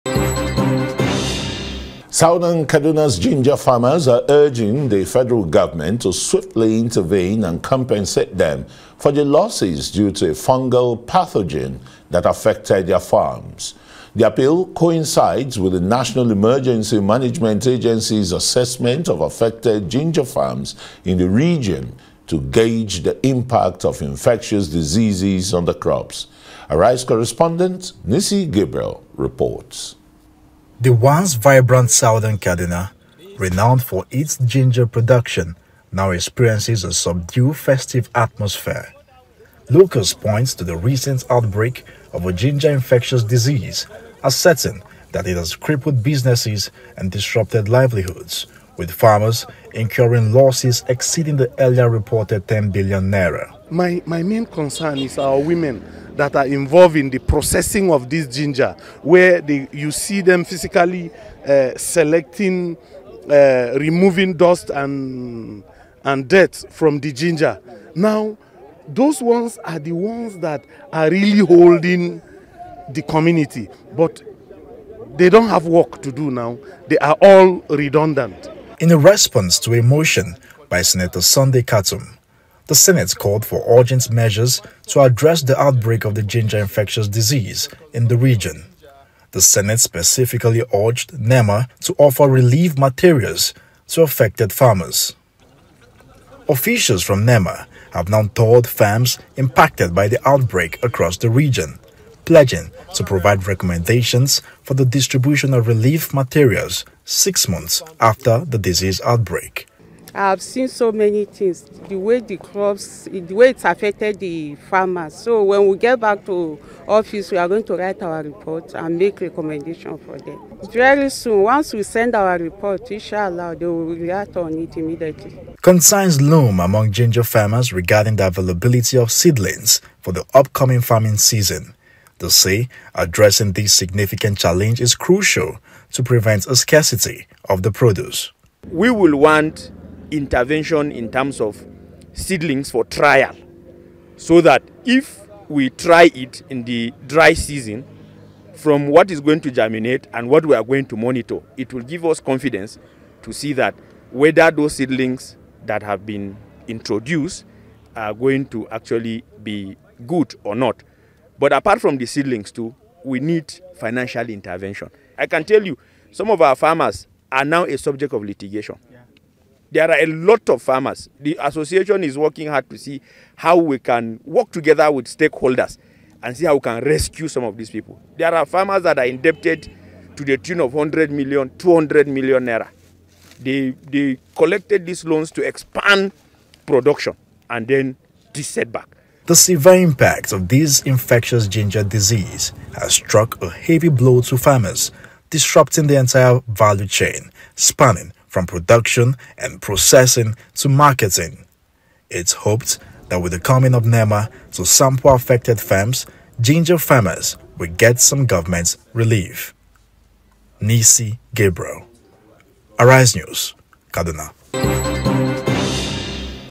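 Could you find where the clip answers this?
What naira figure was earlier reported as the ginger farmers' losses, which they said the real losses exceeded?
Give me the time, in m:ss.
0:52.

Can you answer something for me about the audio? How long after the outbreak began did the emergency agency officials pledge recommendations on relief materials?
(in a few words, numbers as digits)
6 months.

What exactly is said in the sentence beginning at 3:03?
They, they collected these loans to expand production and then this setback.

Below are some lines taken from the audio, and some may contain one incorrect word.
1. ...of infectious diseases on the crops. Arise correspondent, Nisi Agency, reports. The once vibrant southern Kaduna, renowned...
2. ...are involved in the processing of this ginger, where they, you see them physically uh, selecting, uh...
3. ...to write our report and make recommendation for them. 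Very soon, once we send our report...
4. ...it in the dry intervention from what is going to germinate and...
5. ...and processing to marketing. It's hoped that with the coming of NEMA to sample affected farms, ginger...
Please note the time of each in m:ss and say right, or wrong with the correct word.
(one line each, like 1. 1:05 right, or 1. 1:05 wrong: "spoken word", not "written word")
1. 0:23 wrong: "Gabriel", not "Agency"
2. 0:56 right
3. 1:57 right
4. 2:26 wrong: "season", not "intervention"
5. 3:19 right.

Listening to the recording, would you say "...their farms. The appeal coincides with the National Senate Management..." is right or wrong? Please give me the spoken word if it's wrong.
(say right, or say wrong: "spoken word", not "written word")
wrong: "Emergency", not "Senate".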